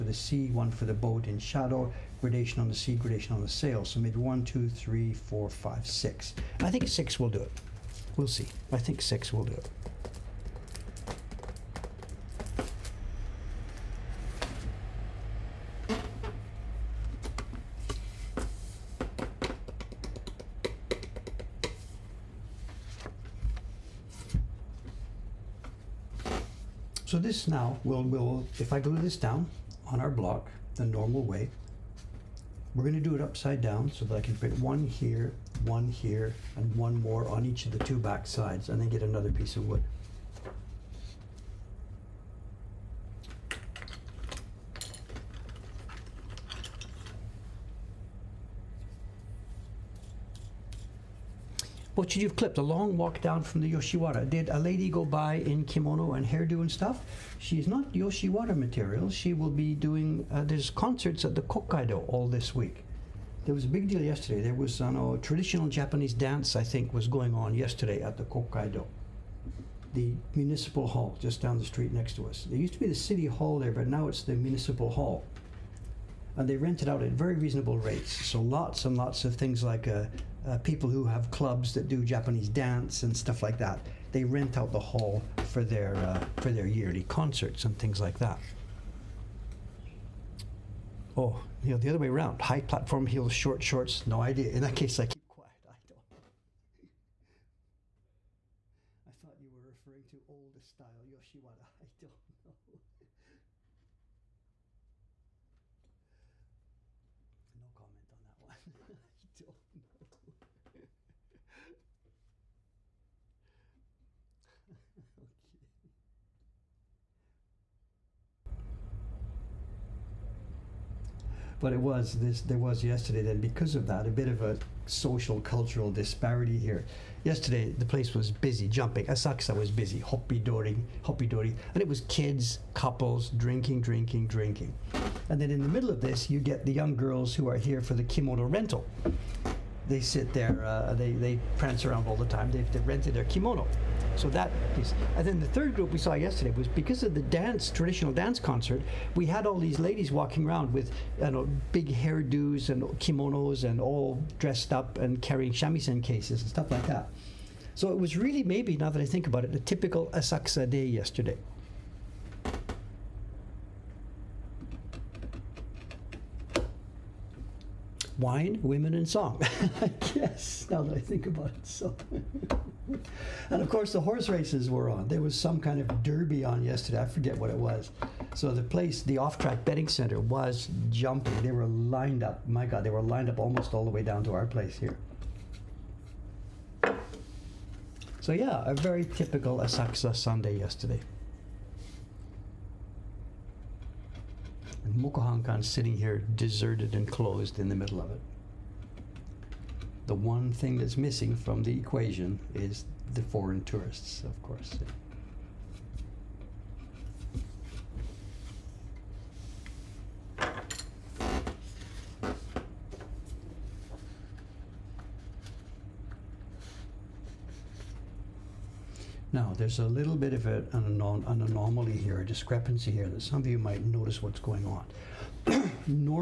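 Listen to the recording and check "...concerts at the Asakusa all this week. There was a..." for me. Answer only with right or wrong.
wrong.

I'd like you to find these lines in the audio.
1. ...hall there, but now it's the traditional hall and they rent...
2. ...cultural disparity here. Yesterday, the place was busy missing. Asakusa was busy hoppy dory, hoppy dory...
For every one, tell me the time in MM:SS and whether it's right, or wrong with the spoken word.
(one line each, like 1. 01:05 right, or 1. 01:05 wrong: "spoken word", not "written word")
1. 01:13 wrong: "municipal", not "traditional"
2. 02:05 wrong: "jumping", not "missing".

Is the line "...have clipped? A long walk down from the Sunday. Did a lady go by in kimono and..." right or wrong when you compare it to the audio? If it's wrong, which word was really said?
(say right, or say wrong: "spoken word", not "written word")
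wrong: "Yoshiwara", not "Sunday".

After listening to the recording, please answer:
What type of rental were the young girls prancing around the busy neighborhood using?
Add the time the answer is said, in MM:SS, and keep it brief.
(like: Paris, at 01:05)
kimono rental, at 02:18.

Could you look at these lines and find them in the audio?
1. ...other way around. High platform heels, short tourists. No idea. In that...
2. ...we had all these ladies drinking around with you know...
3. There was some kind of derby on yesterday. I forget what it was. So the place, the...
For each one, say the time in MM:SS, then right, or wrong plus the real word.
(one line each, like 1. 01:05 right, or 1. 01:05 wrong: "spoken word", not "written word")
1. 01:31 wrong: "shorts", not "tourists"
2. 02:29 wrong: "walking", not "drinking"
3. 02:55 right.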